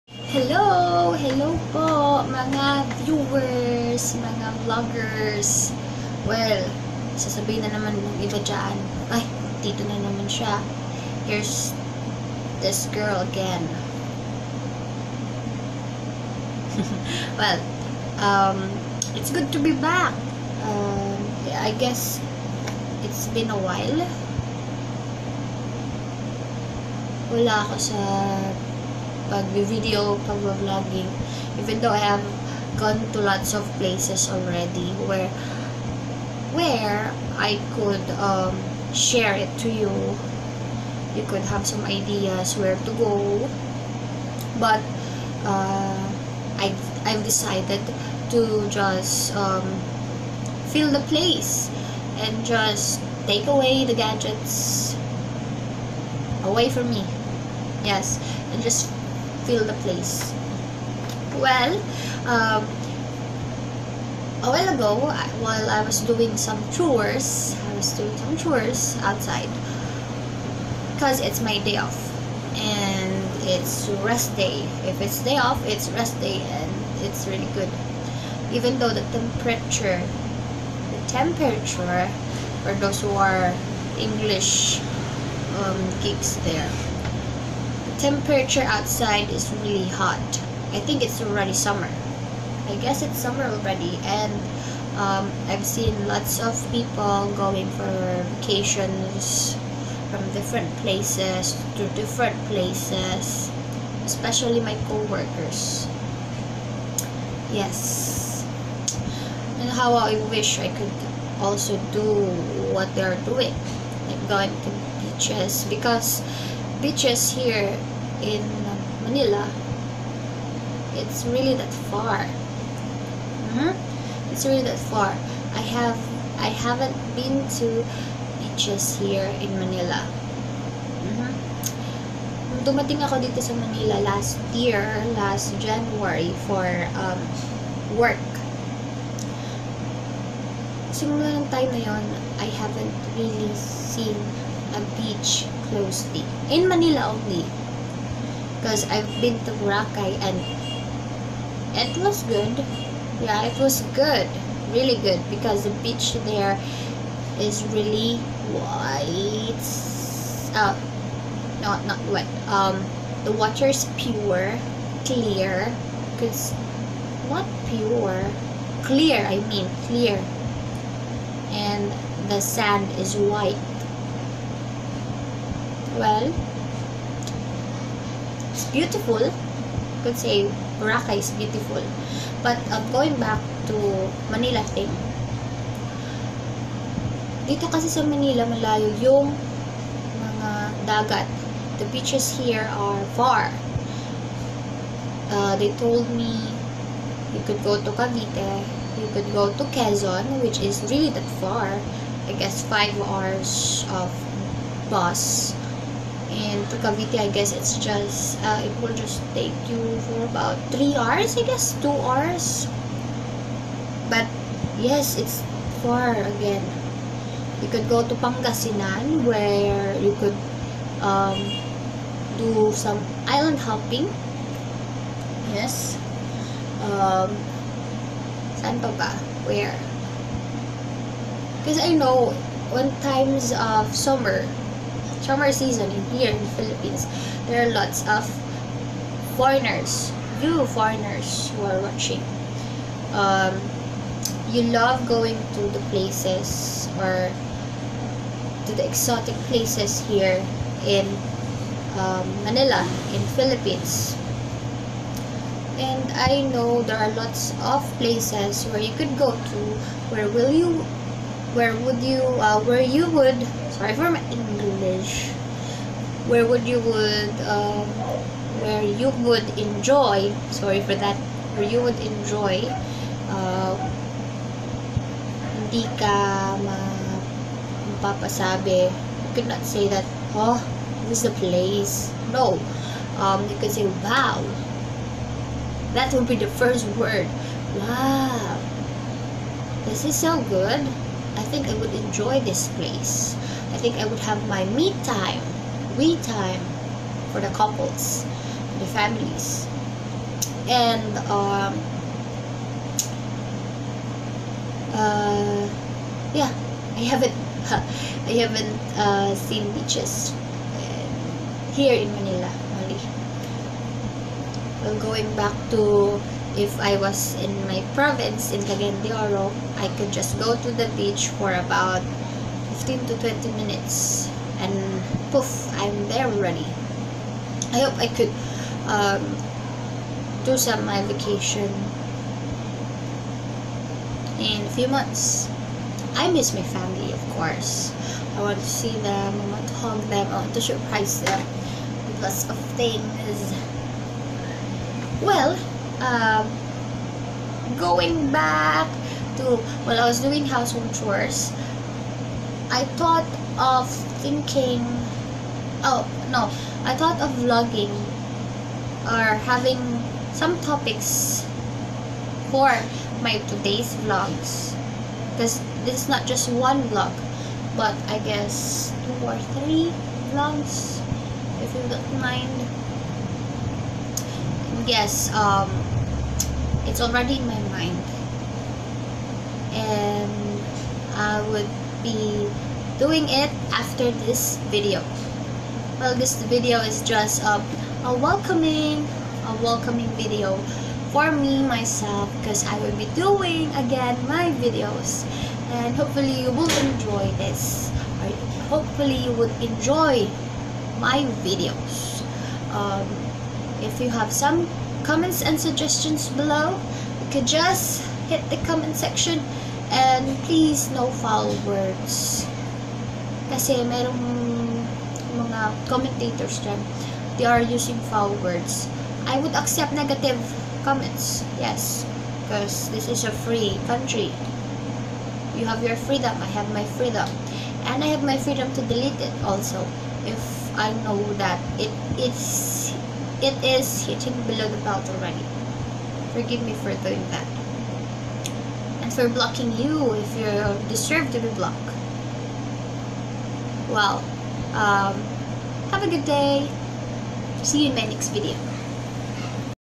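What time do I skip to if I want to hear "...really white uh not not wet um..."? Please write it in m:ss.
2:37.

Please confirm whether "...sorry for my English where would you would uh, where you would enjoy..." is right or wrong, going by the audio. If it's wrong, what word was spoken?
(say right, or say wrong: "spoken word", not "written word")
right.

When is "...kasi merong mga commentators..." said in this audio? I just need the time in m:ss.
6:53.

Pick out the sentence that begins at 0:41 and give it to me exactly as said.
You could have some ideas where to go.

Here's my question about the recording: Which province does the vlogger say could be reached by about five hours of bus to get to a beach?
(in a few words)
Quezon.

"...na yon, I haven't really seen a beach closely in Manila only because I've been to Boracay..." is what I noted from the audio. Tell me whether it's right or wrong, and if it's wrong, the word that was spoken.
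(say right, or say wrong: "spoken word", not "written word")
right.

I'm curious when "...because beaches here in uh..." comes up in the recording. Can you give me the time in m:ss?
1:55.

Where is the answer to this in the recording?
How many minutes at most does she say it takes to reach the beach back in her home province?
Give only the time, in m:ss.
5:23.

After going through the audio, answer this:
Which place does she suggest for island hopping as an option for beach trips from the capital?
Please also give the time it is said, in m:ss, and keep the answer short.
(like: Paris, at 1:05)
Pangasinan, at 3:38.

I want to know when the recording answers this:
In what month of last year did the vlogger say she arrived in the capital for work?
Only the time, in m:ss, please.
2:15.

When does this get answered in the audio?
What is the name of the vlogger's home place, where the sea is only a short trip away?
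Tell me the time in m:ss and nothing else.
5:18.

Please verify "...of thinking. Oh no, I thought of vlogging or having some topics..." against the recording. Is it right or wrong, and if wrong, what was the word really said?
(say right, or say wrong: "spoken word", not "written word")
right.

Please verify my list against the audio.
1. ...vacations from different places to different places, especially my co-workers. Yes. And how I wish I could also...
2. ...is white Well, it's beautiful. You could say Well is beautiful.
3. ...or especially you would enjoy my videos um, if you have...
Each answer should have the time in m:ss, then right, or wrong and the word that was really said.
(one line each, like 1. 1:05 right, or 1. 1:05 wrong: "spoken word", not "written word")
1. 1:38 right
2. 2:52 wrong: "Boracay", not "Well"
3. 6:38 wrong: "hopefully", not "especially".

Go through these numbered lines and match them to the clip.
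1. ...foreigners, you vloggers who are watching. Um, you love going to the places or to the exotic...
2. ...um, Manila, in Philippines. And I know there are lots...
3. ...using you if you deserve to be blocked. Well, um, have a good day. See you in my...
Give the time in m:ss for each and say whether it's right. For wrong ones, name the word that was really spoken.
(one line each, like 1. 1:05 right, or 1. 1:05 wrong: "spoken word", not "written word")
1. 3:59 wrong: "foreigners", not "vloggers"
2. 4:12 right
3. 7:19 wrong: "blocking", not "using".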